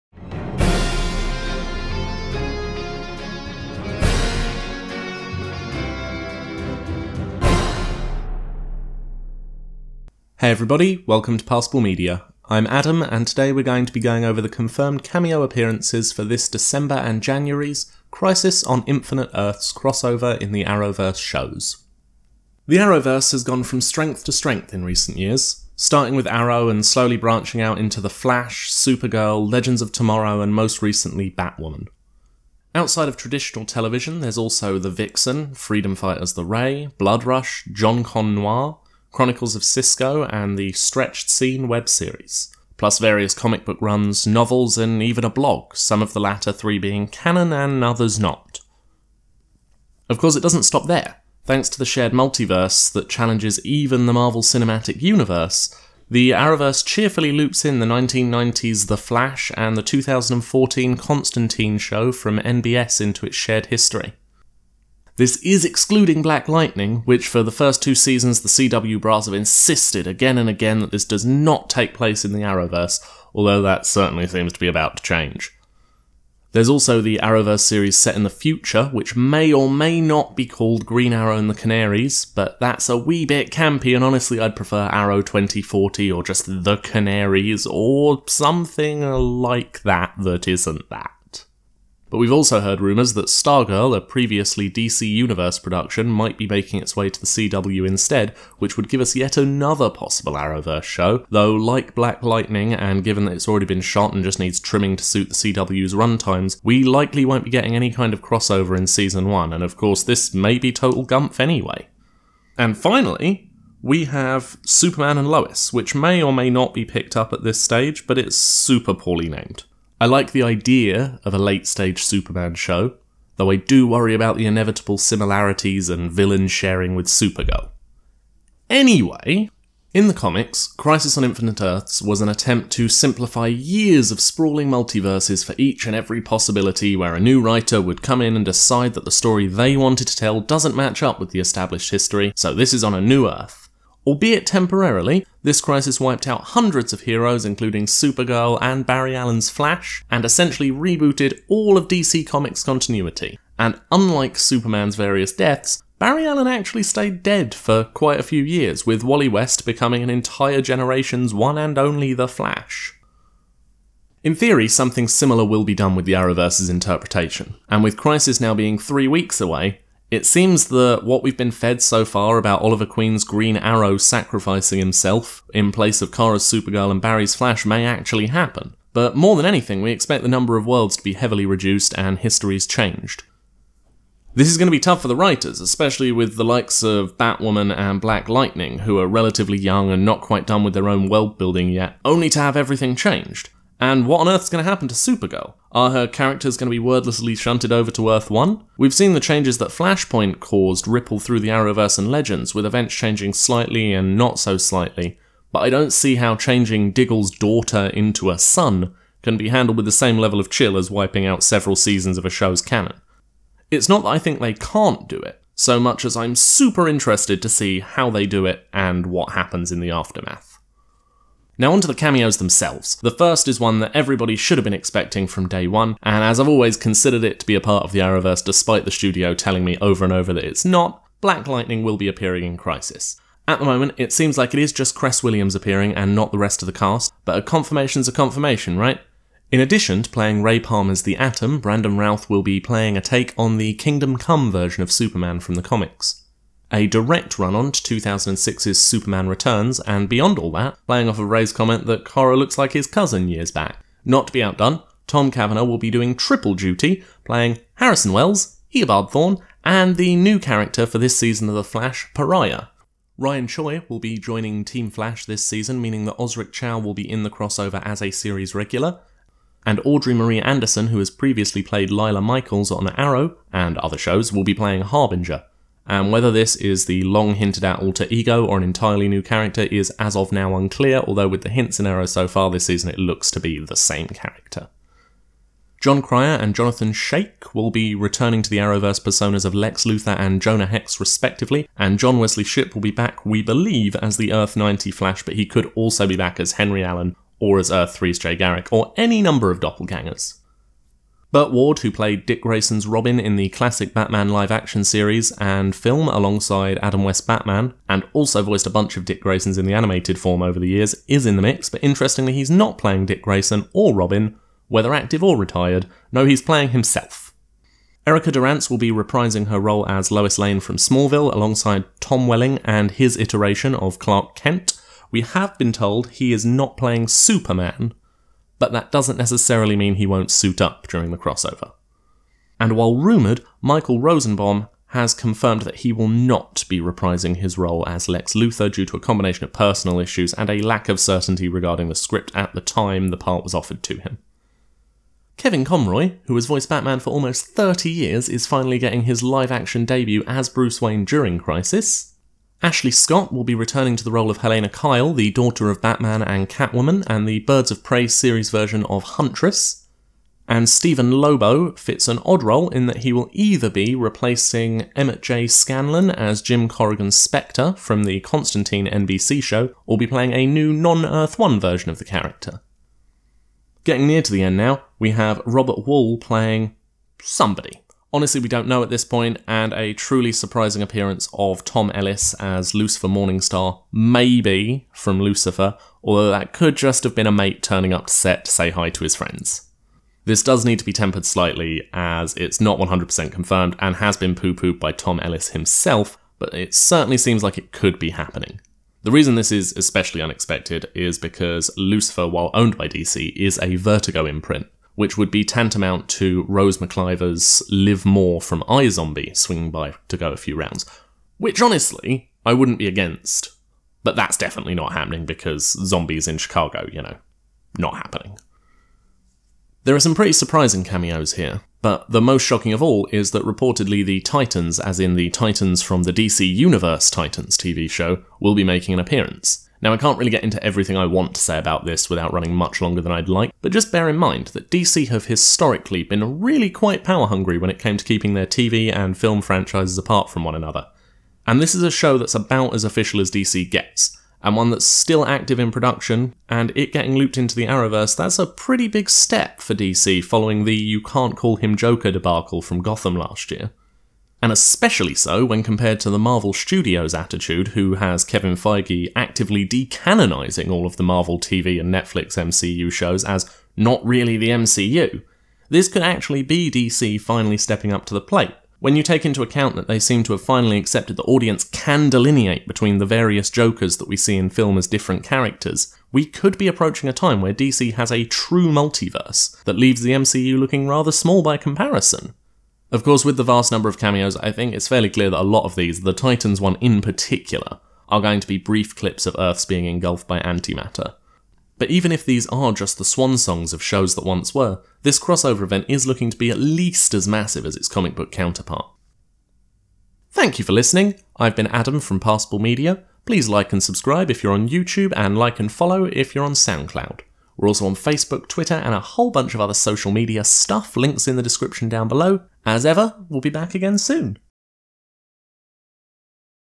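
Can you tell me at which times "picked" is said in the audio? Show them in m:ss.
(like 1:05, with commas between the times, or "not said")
1:56.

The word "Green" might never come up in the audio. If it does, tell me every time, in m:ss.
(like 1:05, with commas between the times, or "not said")
1:20, 2:53.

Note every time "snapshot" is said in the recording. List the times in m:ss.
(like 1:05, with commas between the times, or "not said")
not said.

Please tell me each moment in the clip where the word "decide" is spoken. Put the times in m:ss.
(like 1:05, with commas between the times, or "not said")
2:18.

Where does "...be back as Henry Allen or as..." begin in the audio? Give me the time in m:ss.
4:56.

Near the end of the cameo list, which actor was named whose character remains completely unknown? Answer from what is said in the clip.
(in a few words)
Robert Wuhl.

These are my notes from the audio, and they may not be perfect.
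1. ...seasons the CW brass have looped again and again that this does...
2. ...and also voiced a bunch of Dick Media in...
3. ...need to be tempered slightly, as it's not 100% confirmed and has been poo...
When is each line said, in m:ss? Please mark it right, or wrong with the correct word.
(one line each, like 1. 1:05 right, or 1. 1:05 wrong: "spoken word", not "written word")
1. 1:07 wrong: "insisted", not "looped"
2. 5:07 wrong: "Graysons", not "Media"
3. 6:30 right.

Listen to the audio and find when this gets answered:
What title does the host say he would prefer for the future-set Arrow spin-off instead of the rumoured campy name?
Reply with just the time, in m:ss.
1:24.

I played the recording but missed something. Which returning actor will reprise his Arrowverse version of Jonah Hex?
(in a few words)
Johnathon Schaech.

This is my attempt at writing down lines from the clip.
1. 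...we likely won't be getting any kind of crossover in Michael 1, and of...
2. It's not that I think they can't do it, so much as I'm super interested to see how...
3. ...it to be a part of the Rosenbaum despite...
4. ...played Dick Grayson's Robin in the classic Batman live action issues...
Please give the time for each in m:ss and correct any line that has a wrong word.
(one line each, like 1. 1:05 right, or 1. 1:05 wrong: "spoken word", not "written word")
1. 1:46 wrong: "Season", not "Michael"
2. 3:33 right
3. 3:47 wrong: "Arrowverse", not "Rosenbaum"
4. 5:01 wrong: "series", not "issues".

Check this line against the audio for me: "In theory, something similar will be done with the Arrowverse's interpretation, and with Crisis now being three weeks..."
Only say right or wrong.
right.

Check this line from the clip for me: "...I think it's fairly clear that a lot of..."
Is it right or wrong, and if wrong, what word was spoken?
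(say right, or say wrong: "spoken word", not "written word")
right.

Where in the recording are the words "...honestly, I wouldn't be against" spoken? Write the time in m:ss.
6:51.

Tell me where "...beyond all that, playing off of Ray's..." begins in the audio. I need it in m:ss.
4:10.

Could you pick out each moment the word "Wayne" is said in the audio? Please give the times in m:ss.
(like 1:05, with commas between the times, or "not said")
5:50.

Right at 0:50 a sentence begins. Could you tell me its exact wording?
Of course, it doesn't stop there.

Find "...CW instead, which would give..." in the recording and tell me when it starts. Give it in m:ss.
1:37.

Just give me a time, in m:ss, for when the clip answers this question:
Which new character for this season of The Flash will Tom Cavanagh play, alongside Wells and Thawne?
4:22.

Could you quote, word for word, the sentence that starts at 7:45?
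This could actually be DC finally stepping up to the plate.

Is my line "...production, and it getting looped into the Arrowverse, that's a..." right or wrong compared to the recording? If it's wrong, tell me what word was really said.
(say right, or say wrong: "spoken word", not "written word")
right.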